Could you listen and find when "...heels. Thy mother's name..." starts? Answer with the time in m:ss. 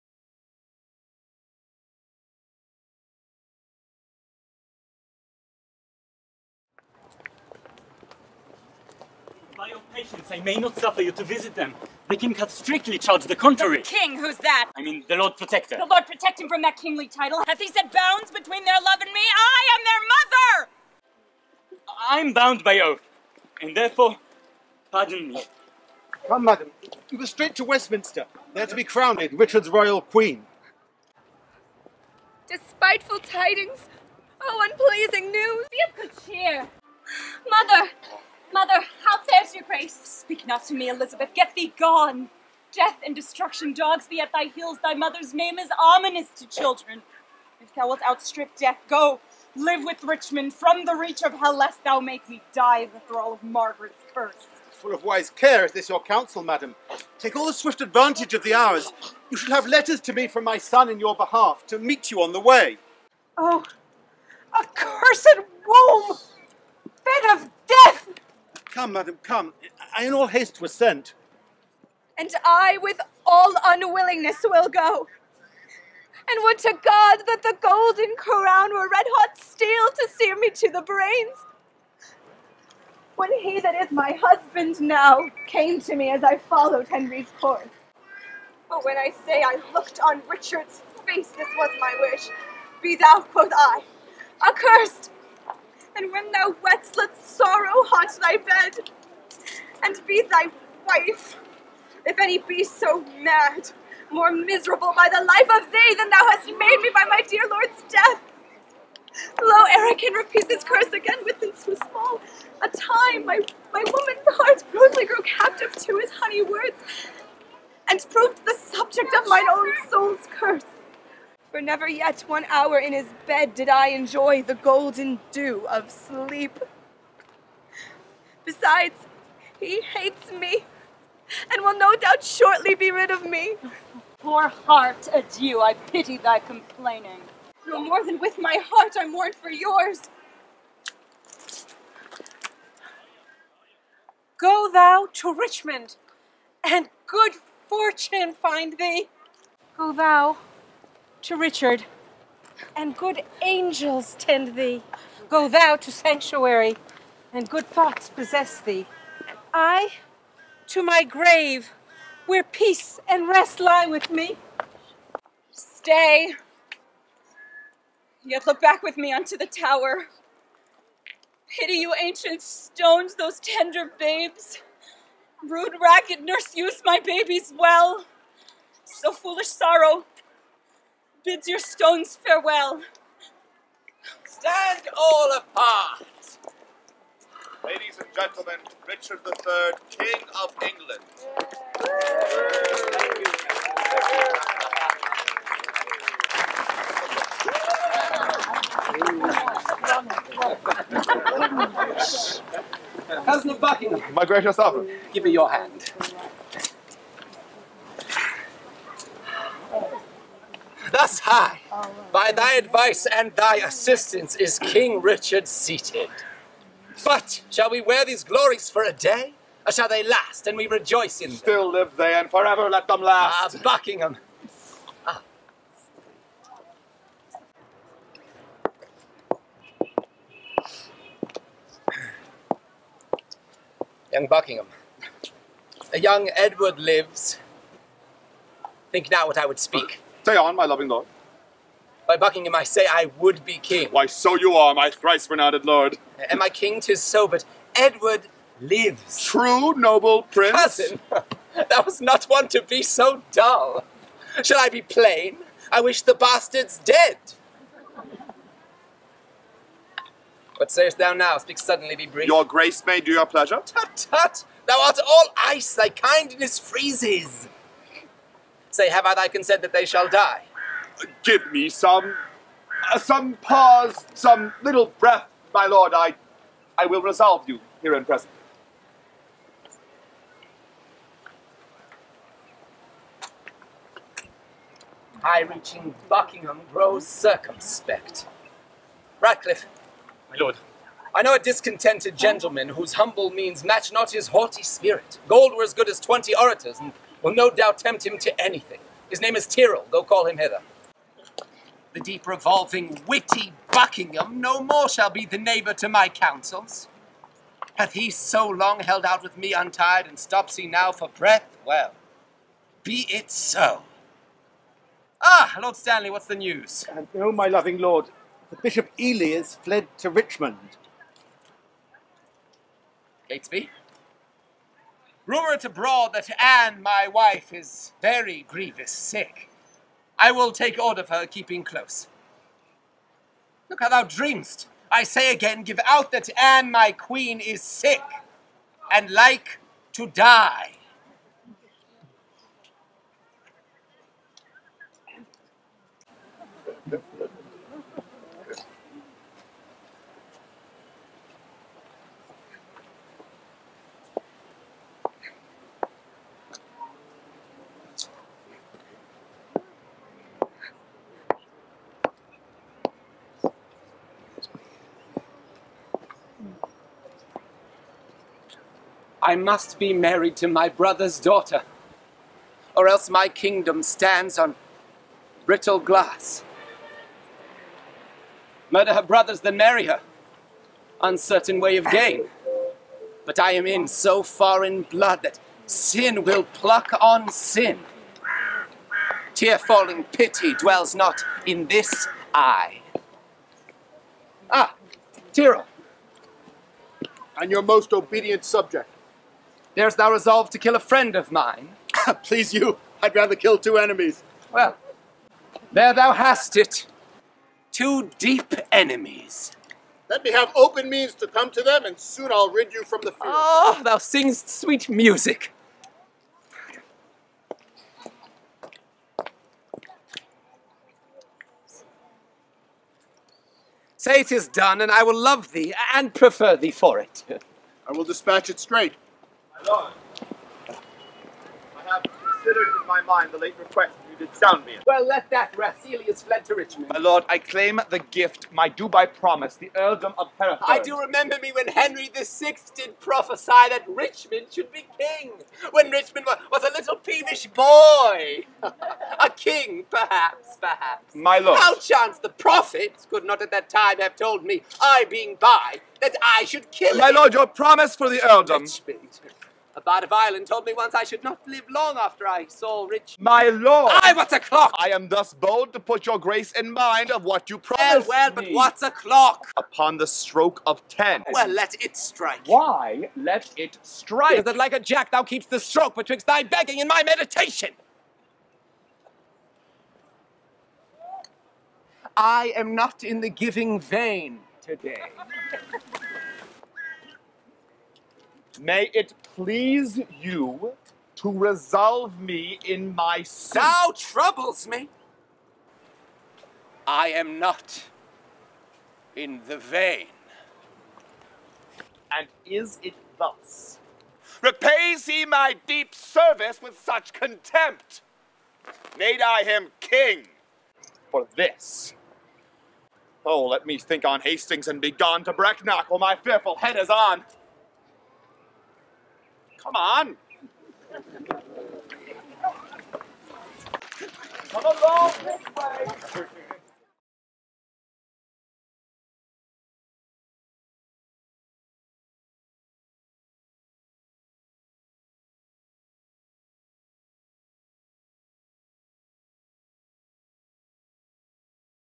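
0:44.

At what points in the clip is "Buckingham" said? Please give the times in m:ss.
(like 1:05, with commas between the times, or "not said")
3:23, 3:43, 3:54, 4:02, 4:46, 5:03.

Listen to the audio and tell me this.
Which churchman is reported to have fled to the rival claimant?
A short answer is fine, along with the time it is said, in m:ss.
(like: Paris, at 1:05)
Bishop Ely, at 5:18.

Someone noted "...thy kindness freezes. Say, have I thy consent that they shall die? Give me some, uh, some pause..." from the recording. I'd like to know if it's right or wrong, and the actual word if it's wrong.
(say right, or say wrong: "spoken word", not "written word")
right.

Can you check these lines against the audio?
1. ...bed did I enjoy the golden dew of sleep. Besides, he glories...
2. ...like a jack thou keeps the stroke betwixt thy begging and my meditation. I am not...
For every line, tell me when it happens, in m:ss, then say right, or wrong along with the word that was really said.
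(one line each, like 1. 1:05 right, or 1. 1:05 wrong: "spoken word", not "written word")
1. 2:03 wrong: "hates", not "glories"
2. 7:54 right.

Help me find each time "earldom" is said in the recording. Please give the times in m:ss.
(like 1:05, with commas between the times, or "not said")
7:19, 7:38.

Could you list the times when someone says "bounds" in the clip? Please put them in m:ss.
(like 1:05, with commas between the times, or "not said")
0:17, 0:22.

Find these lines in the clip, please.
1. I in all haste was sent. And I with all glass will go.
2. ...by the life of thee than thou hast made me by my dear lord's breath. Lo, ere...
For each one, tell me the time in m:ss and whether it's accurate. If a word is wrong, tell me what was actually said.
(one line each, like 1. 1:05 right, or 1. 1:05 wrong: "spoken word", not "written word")
1. 1:09 wrong: "unwillingness", not "glass"
2. 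1:44 wrong: "death", not "breath".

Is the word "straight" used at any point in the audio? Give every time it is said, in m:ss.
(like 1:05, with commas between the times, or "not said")
0:27, 7:08.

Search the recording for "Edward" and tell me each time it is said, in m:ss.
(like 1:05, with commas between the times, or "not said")
3:56, 4:07.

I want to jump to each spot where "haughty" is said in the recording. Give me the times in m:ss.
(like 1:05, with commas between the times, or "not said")
4:54.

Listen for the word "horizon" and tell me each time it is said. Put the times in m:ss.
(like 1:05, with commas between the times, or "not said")
not said.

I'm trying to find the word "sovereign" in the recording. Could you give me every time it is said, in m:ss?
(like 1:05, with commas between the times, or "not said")
3:24.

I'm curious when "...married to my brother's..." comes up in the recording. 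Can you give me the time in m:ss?
6:09.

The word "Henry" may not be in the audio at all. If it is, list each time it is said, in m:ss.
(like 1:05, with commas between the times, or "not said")
1:26, 7:21.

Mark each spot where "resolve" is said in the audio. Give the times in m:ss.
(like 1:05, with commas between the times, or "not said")
4:37, 6:40, 8:11.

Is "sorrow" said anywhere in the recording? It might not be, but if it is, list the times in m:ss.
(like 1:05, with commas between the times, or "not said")
1:37, 2:59.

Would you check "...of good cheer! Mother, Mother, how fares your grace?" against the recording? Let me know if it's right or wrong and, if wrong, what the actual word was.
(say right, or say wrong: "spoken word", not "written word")
right.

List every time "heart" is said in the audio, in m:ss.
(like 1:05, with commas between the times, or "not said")
1:54, 2:14, 2:18.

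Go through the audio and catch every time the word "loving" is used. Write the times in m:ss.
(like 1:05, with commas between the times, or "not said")
4:00, 5:17.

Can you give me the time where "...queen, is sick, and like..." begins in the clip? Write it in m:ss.
5:36.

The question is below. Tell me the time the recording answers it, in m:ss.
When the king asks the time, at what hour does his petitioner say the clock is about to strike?
7:50.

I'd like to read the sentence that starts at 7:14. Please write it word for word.
Well, let that Rasselius fled to Richmond.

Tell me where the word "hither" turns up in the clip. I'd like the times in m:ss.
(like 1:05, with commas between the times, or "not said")
5:00.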